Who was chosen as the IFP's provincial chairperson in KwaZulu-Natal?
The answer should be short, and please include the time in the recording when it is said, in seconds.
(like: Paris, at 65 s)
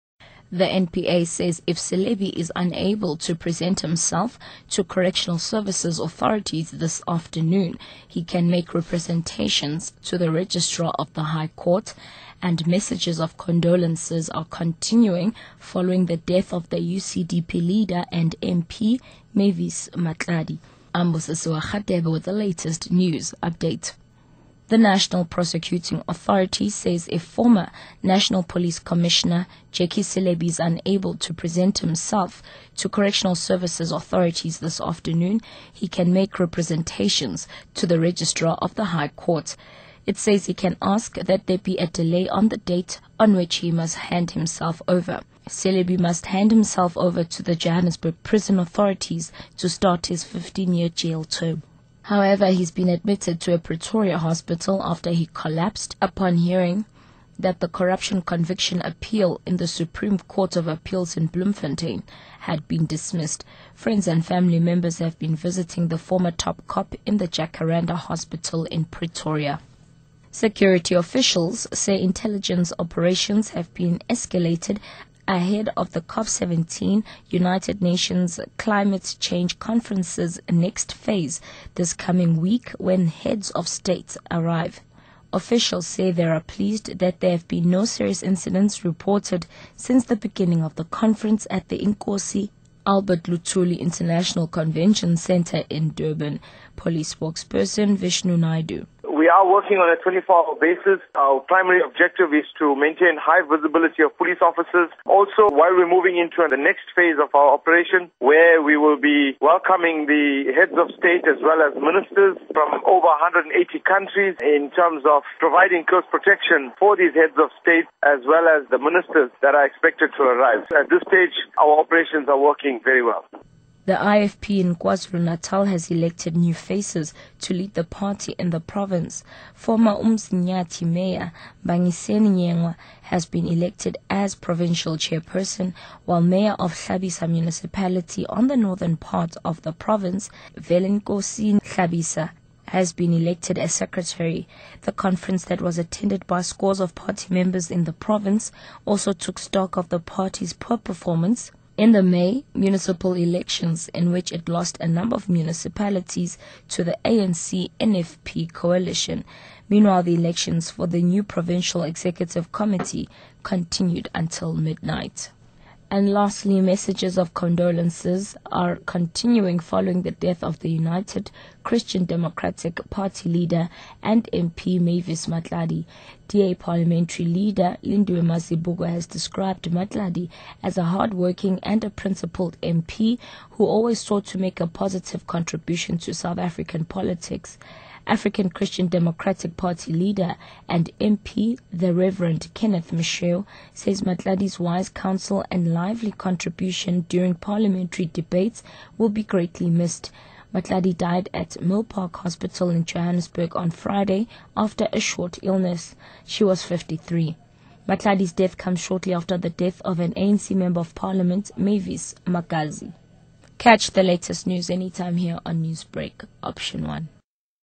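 Bangiseni Nyengwa, at 131 s.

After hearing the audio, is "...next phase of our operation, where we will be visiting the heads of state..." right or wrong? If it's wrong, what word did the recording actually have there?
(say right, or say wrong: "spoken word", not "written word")
wrong: "welcoming", not "visiting".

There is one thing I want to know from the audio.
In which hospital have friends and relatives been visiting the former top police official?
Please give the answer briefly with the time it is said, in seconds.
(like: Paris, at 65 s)
Jacaranda Hospital, at 67 s.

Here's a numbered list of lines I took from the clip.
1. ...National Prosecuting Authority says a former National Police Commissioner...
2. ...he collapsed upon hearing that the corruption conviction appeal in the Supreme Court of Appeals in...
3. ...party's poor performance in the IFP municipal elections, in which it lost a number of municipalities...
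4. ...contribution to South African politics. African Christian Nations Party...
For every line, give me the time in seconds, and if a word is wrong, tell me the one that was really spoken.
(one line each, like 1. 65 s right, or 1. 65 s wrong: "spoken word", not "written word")
1. 24 s right
2. 55 s right
3. 149 s wrong: "May", not "IFP"
4. 185 s wrong: "Democratic", not "Nations".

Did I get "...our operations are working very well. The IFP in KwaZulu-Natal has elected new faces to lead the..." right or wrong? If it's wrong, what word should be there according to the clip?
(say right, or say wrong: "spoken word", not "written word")
right.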